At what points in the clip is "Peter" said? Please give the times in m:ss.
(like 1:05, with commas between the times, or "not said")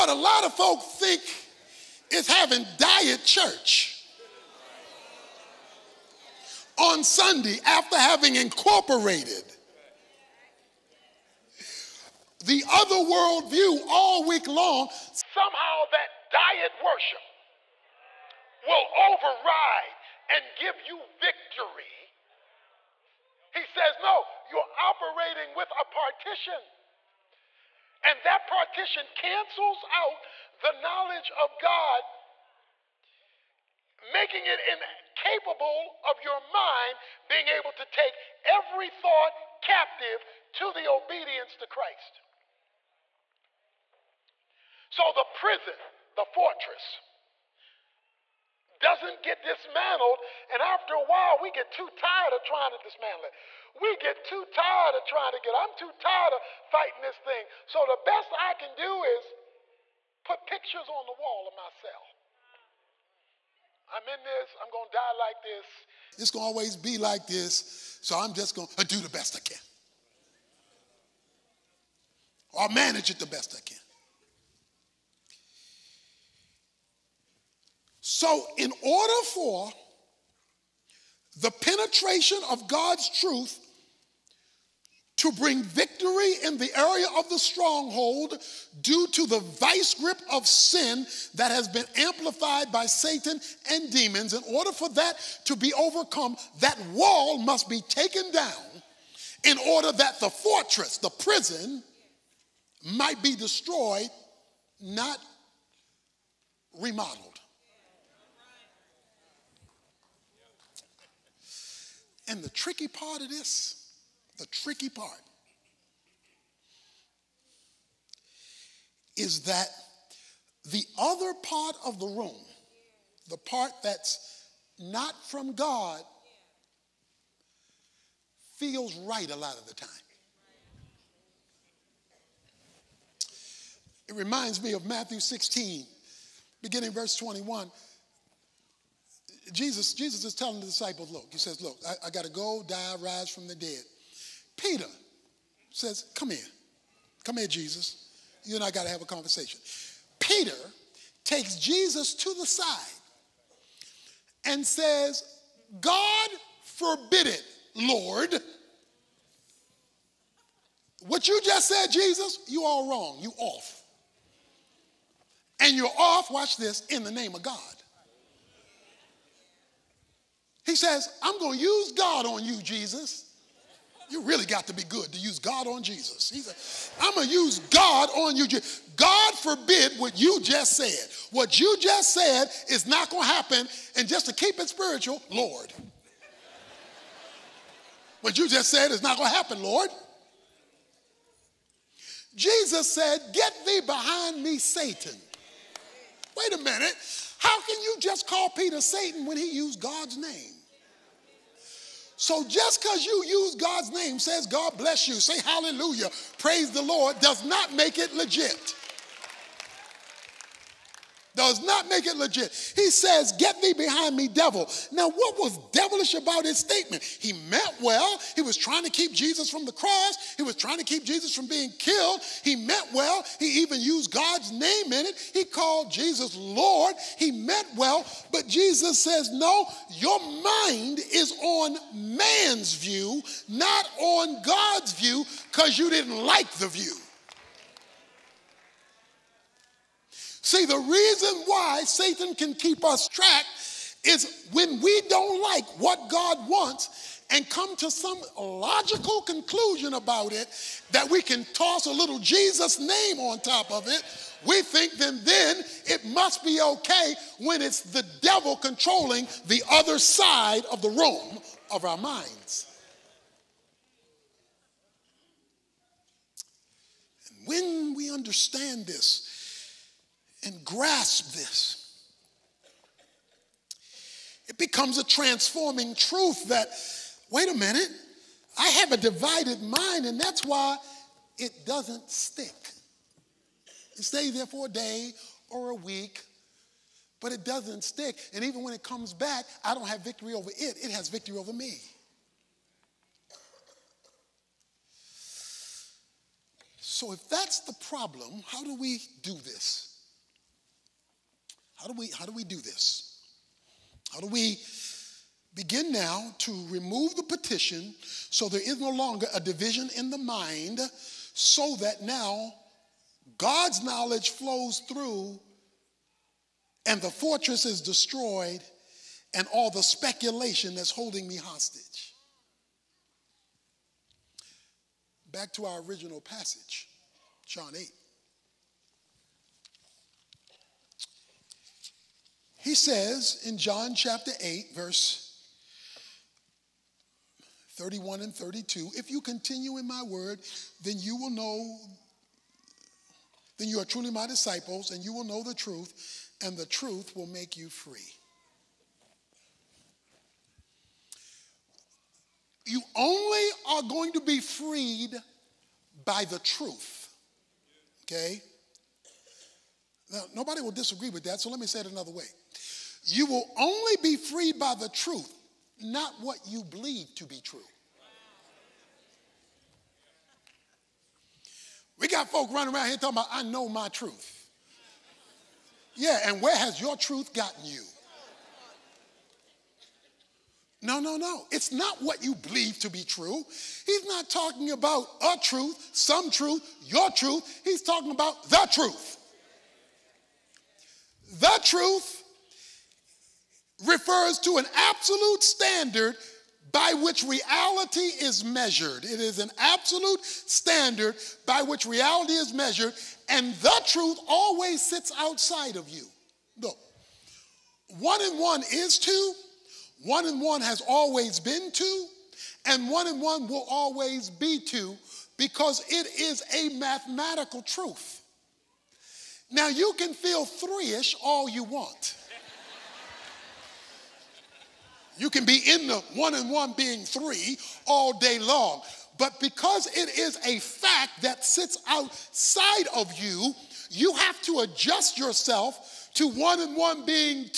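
2:24, 2:30, 3:18.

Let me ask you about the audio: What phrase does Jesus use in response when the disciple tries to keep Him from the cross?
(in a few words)
Get thee behind me, Satan.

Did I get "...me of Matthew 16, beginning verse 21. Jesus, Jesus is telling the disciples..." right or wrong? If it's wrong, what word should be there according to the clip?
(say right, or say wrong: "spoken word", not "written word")
right.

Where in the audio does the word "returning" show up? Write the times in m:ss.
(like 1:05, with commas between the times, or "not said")
not said.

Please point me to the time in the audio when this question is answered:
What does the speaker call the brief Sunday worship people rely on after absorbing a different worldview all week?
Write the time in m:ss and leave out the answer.
0:02.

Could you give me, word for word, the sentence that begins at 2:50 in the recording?
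He says, I'm going to use God on you, Jesus.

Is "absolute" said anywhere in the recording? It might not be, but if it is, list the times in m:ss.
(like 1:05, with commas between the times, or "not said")
6:34, 6:39.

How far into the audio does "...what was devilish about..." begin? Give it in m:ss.
3:35.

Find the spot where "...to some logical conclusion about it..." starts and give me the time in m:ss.
4:07.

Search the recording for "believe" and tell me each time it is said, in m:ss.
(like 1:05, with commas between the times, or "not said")
6:06, 6:22.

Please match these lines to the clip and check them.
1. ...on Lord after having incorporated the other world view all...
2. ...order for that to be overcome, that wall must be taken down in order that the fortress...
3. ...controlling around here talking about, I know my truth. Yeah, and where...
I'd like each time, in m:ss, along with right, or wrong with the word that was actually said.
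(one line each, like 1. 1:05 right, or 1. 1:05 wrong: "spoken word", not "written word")
1. 0:06 wrong: "Sunday", not "Lord"
2. 1:34 right
3. 6:12 wrong: "running", not "controlling".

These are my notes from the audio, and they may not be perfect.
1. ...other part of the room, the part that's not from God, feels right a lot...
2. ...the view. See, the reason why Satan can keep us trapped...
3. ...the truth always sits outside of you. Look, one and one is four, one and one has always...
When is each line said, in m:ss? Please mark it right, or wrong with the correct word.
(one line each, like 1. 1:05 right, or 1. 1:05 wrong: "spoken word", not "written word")
1. 2:00 right
2. 3:56 right
3. 6:43 wrong: "two", not "four".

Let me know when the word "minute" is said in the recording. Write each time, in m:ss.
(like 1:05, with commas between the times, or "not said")
3:16, 4:37.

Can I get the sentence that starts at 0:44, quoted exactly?
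So the prison, the fortress, doesn't get dismantled.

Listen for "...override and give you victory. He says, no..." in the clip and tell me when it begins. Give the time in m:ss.
0:18.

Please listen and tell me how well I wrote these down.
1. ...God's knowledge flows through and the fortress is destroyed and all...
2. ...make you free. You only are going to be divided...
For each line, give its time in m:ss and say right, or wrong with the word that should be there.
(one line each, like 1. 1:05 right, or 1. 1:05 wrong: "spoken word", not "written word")
1. 5:13 right
2. 5:47 wrong: "freed", not "divided".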